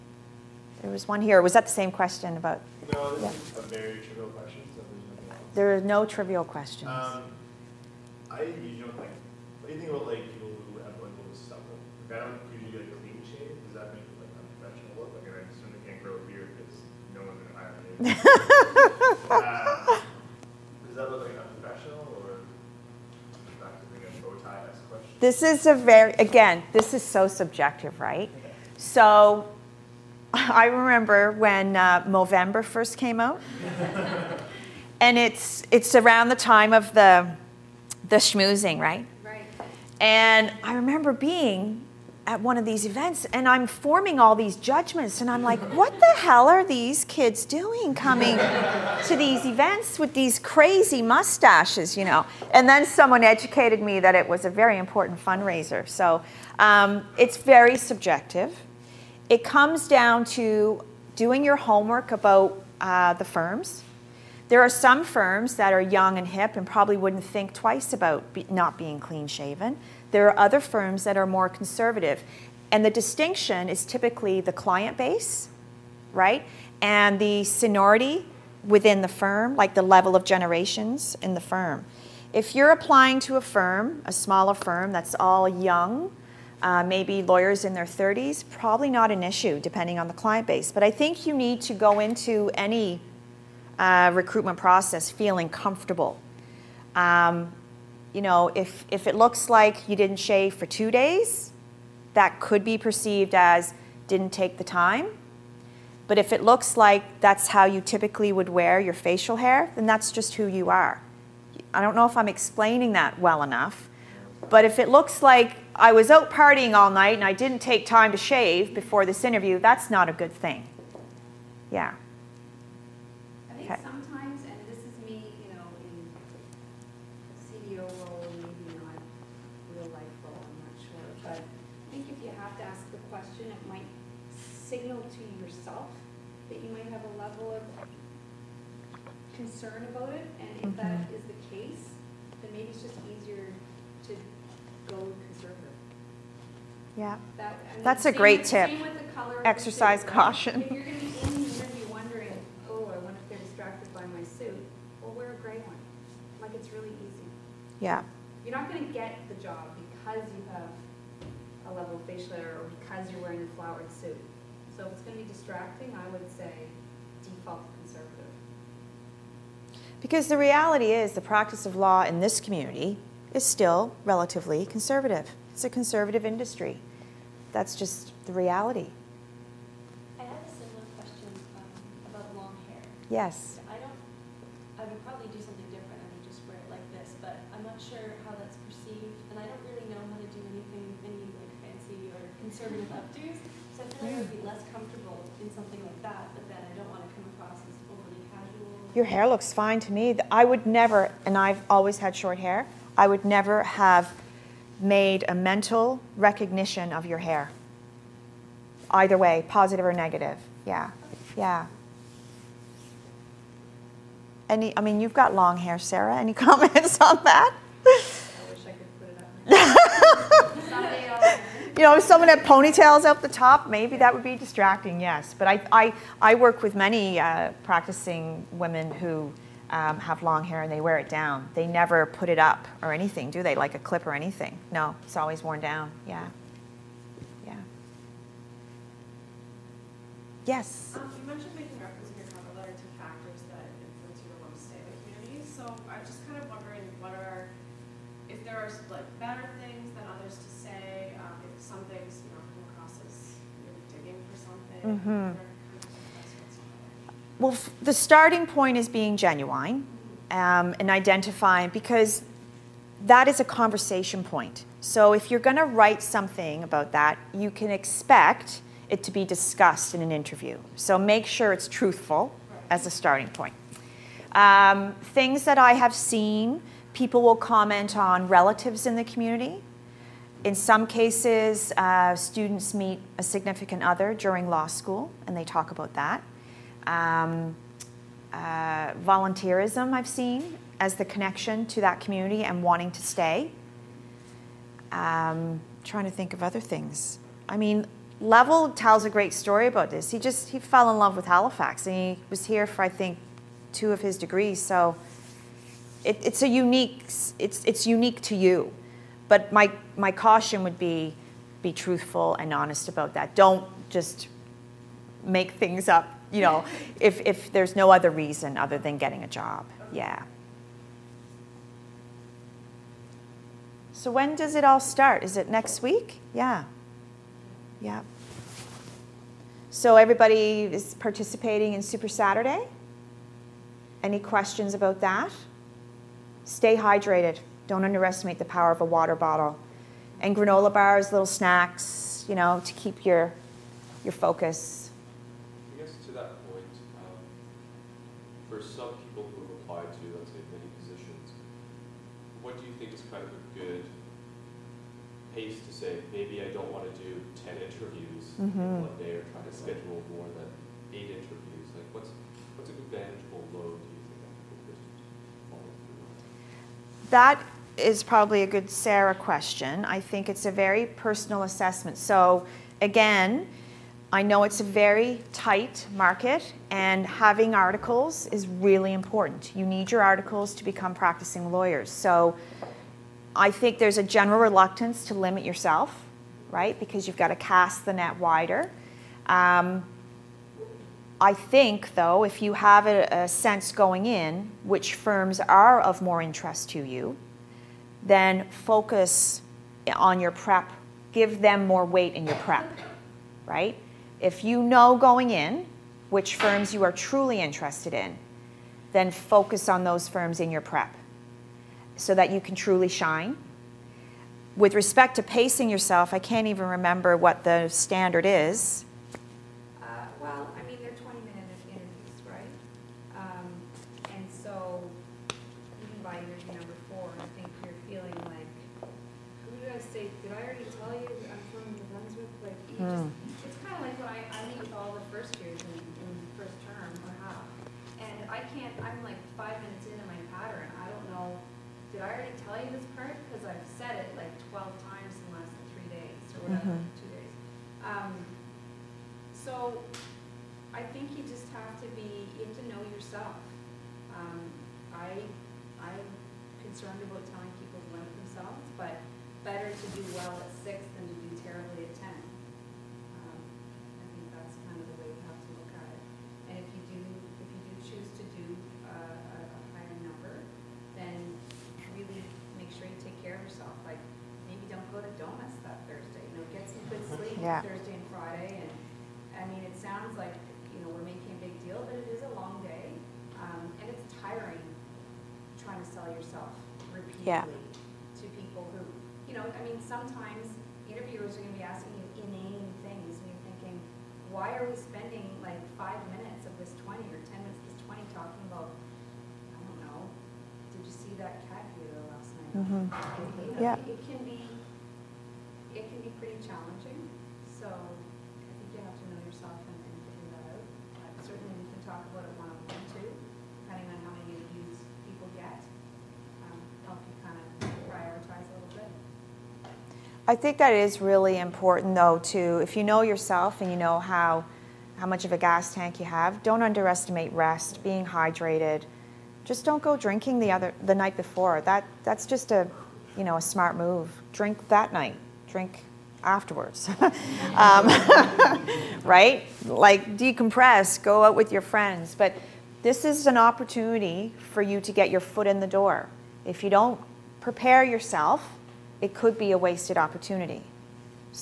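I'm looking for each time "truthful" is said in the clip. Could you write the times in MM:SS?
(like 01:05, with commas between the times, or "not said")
04:31, 05:11.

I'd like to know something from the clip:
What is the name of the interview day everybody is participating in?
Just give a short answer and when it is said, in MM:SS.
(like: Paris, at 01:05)
Super Saturday, at 05:31.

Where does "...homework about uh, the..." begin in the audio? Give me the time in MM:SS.
01:01.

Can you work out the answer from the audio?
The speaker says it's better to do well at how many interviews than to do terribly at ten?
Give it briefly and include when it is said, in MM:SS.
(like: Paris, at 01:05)
6, at 07:40.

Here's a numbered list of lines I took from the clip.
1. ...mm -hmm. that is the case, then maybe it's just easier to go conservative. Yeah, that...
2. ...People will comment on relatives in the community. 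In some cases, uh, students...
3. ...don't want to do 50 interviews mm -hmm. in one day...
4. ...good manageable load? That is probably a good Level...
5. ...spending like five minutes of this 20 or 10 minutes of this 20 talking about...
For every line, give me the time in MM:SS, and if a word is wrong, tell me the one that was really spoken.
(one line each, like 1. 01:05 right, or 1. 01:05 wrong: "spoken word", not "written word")
1. 02:20 right
2. 04:36 right
3. 05:56 wrong: "10", not "50"
4. 06:02 wrong: "Sarah", not "Level"
5. 08:14 right.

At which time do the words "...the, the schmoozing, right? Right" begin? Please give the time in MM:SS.
00:36.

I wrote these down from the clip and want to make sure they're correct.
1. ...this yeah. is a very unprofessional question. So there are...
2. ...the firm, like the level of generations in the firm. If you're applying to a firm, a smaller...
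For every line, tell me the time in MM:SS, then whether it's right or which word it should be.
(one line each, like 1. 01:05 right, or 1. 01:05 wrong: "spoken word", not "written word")
1. 00:03 wrong: "trivial", not "unprofessional"
2. 01:19 right.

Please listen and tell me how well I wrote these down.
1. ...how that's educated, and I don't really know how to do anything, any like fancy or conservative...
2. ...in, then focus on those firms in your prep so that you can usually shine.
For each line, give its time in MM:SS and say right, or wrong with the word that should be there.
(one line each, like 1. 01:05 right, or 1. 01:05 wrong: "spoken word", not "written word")
1. 03:08 wrong: "perceived", not "educated"
2. 06:47 wrong: "truly", not "usually".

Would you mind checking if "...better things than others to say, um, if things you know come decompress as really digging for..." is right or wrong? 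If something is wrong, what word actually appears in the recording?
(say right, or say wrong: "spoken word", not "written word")
wrong: "across", not "decompress".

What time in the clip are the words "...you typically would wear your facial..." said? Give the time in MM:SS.
01:47.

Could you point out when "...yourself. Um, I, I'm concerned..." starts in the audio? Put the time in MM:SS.
07:32.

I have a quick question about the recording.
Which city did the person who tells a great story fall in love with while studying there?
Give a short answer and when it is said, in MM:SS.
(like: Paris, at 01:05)
Halifax, at 05:01.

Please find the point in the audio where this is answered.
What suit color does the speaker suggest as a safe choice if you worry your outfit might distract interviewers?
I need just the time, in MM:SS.
02:35.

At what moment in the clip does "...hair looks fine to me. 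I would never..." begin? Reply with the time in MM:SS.
03:19.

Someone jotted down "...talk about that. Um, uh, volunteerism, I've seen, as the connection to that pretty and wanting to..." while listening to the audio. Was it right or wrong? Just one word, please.
wrong.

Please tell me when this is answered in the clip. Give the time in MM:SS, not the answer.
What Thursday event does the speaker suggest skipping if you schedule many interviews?
07:55.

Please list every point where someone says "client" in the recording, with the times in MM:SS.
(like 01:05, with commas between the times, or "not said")
01:14, 01:30.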